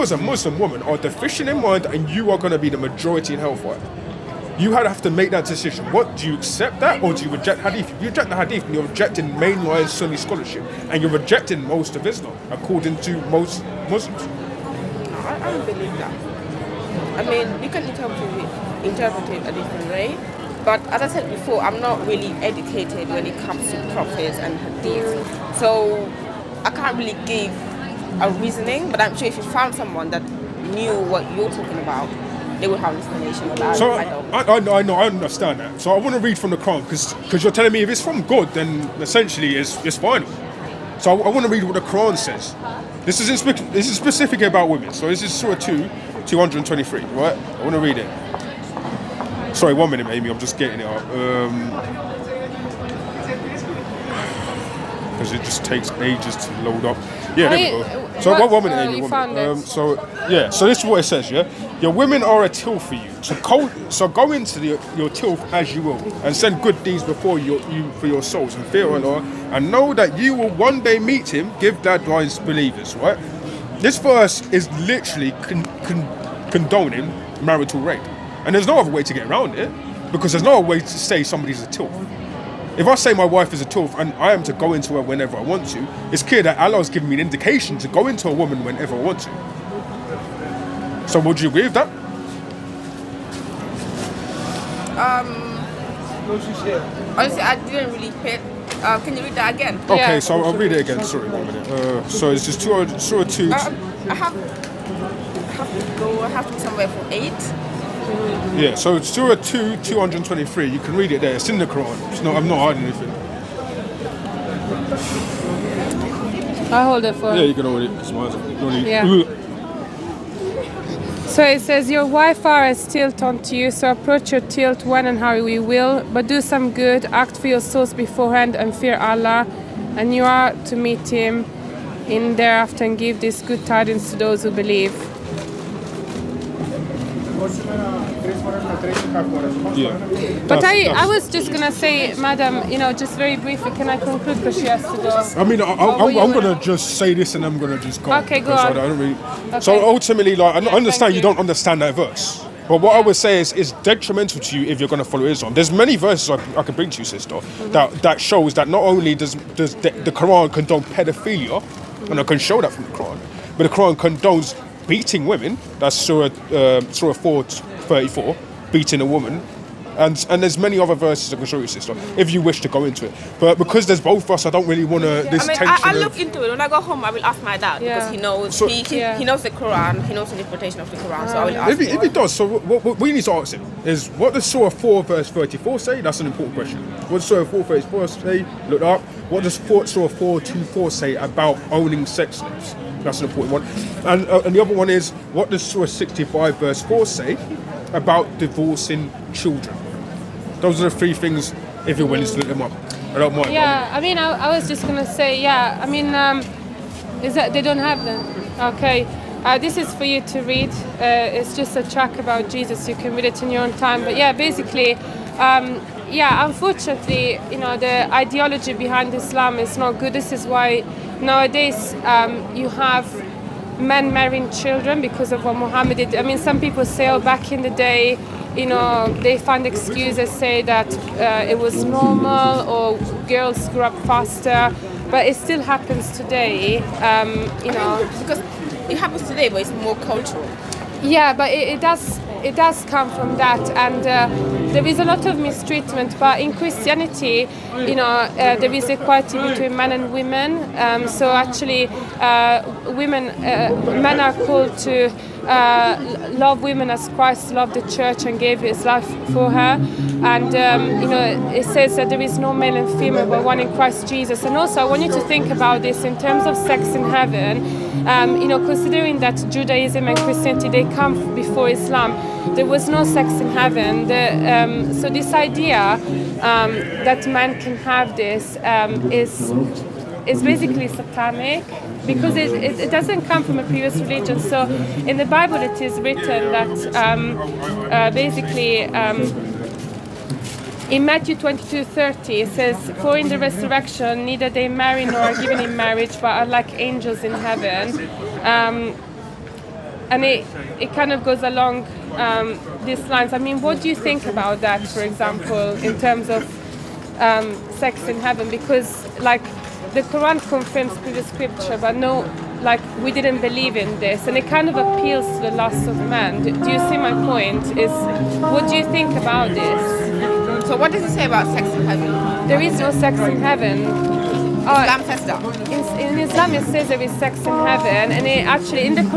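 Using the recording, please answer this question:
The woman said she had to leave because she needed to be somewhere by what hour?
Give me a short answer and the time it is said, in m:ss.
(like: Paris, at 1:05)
8, at 1:47.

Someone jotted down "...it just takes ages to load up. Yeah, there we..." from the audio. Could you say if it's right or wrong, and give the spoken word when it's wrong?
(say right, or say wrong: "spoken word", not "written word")
right.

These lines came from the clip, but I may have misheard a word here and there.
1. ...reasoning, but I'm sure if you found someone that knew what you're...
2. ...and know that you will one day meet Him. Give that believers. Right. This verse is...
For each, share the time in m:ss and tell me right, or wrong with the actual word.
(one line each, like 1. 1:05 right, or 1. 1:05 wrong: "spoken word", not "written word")
1. 0:28 right
2. 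1:09 right.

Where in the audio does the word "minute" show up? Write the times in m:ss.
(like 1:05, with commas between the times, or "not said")
0:49, 0:58, 1:41.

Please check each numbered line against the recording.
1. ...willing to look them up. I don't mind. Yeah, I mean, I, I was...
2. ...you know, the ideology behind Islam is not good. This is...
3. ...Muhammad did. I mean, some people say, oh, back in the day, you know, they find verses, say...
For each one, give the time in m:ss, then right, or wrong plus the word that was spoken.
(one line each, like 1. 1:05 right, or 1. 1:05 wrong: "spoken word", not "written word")
1. 3:22 right
2. 3:37 right
3. 3:45 wrong: "excuses", not "verses".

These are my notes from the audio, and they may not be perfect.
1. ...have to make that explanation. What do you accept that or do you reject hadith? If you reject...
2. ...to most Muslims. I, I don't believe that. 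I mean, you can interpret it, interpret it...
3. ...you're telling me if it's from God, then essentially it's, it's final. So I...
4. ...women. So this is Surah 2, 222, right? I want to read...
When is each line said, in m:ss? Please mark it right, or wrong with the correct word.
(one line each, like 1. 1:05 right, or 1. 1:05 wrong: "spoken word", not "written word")
1. 0:04 wrong: "decision", not "explanation"
2. 0:13 right
3. 0:37 right
4. 0:44 wrong: "223", not "222".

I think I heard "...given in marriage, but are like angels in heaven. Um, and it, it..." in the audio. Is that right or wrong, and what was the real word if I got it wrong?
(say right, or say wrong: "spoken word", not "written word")
right.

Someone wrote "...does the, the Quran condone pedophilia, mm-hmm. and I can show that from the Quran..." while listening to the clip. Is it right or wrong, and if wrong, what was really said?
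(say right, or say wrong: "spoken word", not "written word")
right.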